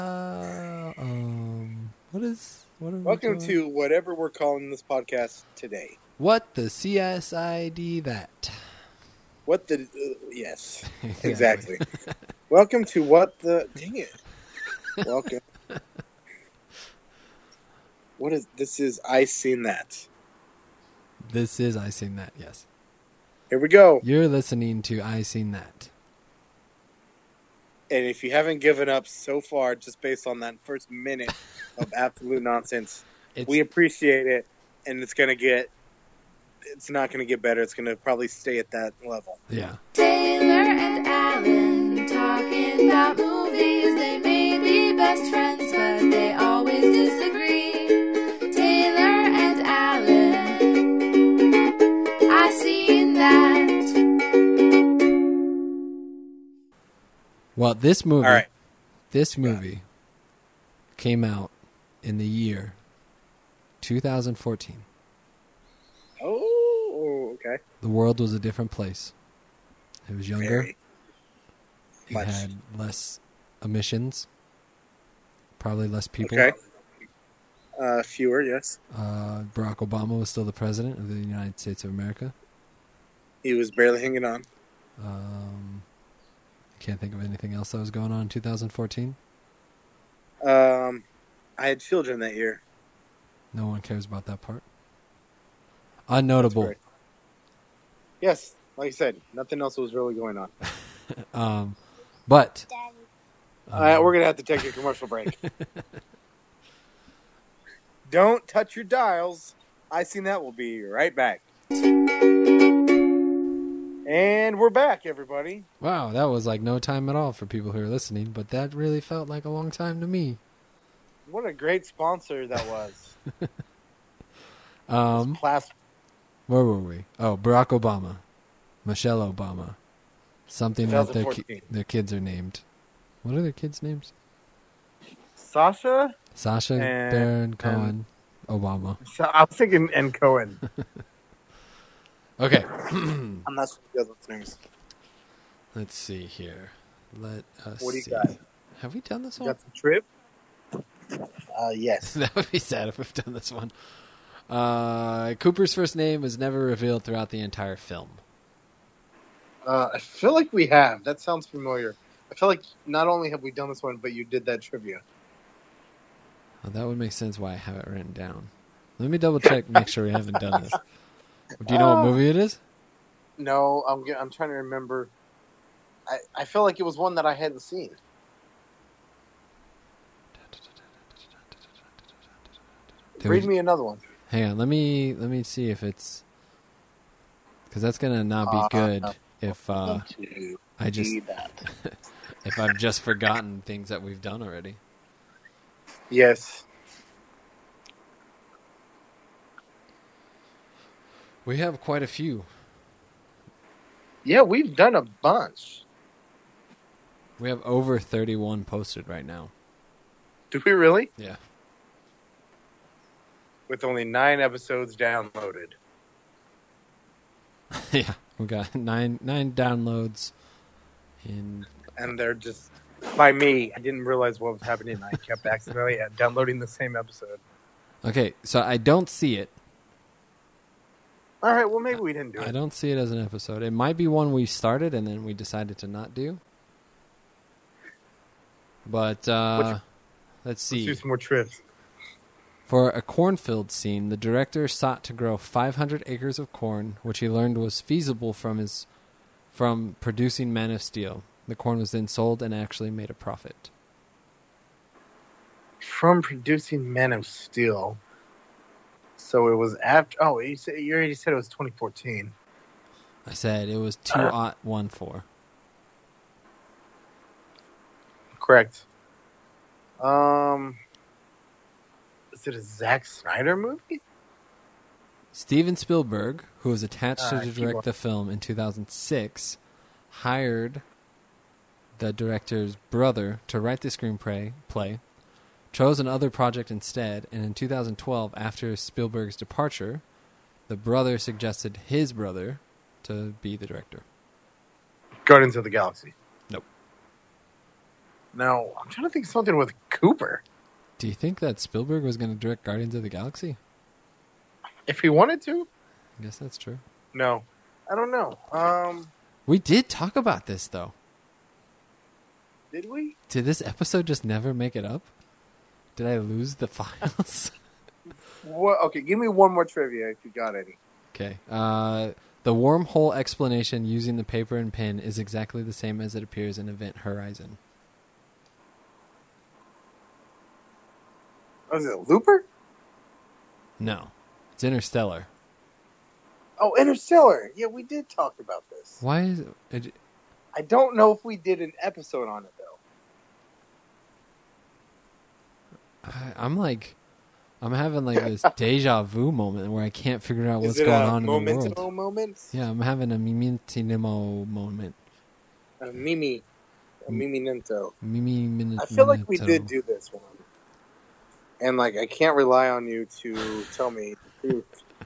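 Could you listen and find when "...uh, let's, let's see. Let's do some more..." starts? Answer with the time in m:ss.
3:59.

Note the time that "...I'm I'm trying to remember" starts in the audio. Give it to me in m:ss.
2:53.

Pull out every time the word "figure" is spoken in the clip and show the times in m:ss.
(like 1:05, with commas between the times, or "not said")
5:50.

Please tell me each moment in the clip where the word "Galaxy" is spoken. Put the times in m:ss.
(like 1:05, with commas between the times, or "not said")
4:55, 5:03.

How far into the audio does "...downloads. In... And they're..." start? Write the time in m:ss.
3:39.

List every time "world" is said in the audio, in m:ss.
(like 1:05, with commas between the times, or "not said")
1:07, 5:51.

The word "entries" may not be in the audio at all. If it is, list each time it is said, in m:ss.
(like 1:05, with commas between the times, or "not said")
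not said.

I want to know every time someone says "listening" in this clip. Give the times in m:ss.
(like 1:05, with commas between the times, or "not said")
0:24, 1:57.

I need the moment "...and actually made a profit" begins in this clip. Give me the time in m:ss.
4:12.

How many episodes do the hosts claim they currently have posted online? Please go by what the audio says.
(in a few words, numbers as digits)
31.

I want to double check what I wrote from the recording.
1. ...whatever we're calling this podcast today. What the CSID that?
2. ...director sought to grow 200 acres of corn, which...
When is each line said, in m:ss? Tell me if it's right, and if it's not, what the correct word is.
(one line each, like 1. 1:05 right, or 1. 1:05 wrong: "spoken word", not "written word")
1. 0:03 right
2. 4:04 wrong: "500", not "200".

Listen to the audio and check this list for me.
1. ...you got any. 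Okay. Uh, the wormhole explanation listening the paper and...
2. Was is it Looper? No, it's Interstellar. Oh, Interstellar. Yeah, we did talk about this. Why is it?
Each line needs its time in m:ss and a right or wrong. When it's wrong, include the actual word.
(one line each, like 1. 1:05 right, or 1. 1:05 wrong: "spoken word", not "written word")
1. 5:20 wrong: "using", not "listening"
2. 5:31 right.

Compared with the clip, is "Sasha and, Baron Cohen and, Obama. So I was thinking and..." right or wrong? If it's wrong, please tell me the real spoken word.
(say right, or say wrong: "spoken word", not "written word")
right.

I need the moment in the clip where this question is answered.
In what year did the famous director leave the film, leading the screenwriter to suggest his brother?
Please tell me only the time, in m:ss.
4:47.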